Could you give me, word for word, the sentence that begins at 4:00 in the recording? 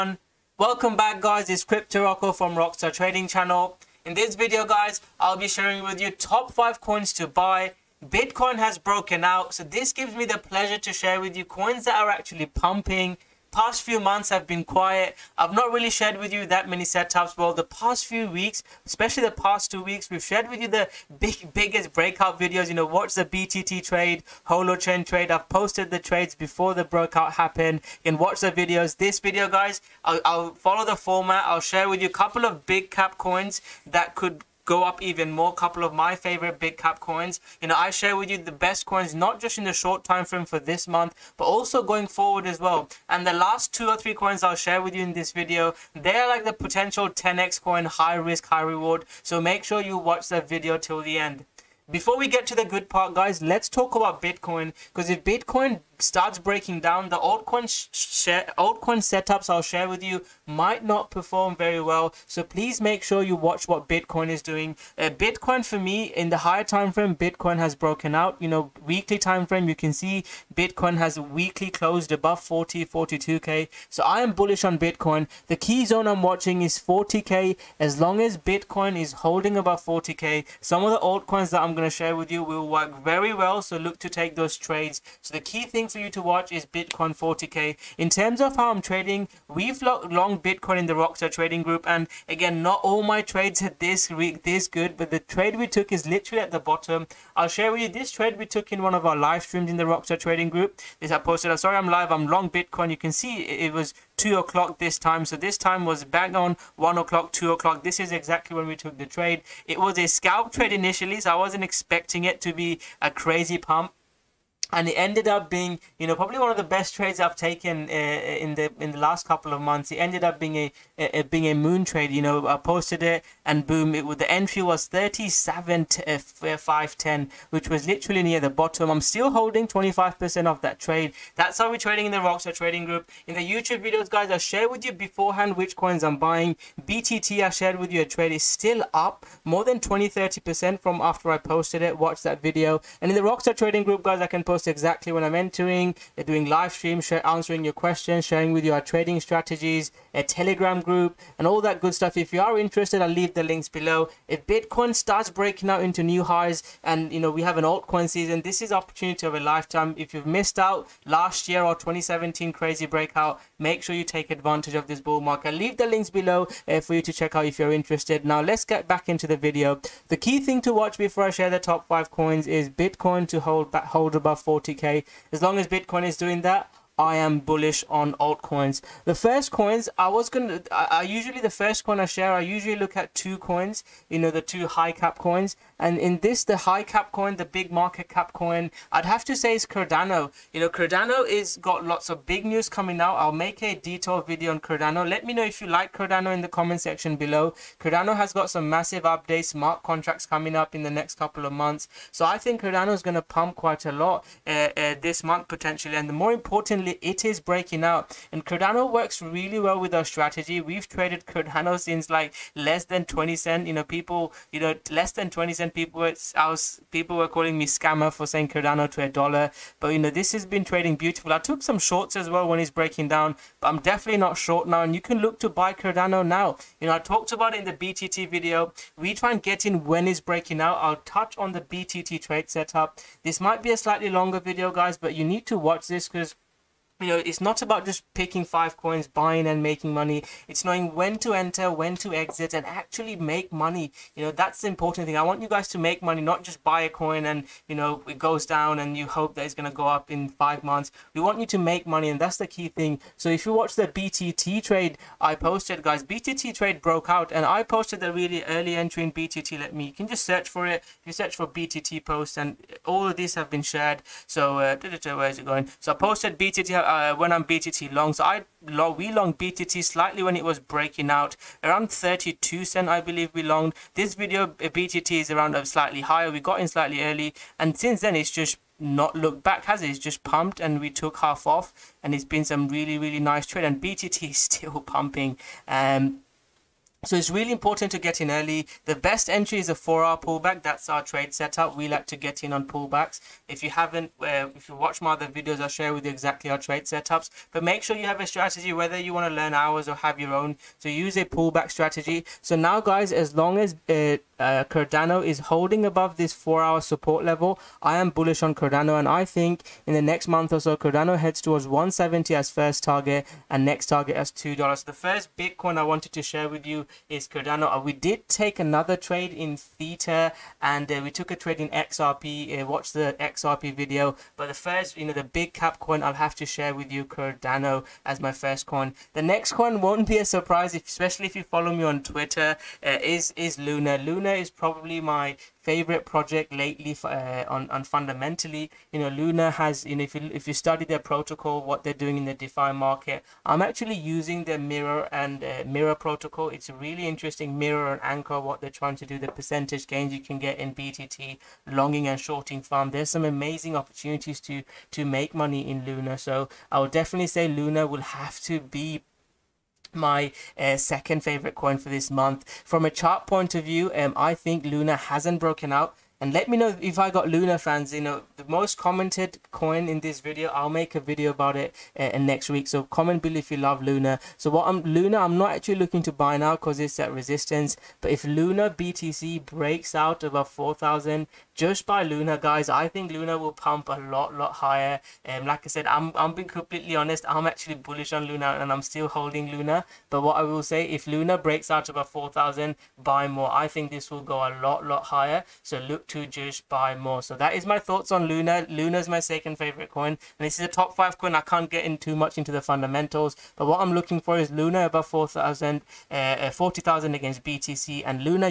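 It's knowing when to enter, when to exit, and actually make money.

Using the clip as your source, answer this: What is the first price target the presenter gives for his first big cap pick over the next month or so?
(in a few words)
170.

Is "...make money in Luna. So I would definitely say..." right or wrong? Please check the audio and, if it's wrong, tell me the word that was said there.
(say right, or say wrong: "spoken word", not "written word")
right.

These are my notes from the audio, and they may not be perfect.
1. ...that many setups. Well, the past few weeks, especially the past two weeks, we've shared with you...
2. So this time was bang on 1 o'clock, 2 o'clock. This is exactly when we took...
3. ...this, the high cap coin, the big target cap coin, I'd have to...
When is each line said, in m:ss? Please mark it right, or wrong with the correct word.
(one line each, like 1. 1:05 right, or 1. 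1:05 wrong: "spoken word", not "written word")
1. 0:16 right
2. 1:45 right
3. 3:06 wrong: "market", not "target".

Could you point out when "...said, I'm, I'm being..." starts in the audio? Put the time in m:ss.
6:25.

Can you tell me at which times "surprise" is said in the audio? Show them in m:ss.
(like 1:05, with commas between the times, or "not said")
5:30.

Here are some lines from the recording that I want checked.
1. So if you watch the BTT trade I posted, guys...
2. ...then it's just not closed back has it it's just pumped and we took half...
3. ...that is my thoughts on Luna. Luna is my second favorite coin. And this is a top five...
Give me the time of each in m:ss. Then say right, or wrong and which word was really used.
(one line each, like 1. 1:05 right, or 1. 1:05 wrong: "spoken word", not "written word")
1. 4:13 right
2. 4:38 wrong: "looked", not "closed"
3. 6:37 right.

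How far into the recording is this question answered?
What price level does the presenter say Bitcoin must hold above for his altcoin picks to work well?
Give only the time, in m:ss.
1:15.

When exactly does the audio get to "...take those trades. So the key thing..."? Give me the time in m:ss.
1:24.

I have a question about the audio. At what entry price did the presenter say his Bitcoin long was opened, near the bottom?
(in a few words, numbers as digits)
37,510.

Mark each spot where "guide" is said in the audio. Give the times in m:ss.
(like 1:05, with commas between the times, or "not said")
not said.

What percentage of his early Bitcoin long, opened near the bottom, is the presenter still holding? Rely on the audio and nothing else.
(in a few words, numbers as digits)
25%.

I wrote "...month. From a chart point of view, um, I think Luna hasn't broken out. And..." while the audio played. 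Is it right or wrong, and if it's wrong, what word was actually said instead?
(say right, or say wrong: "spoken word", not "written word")
right.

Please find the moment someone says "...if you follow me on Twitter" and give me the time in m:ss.
5:31.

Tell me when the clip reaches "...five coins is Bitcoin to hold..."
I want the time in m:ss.
2:51.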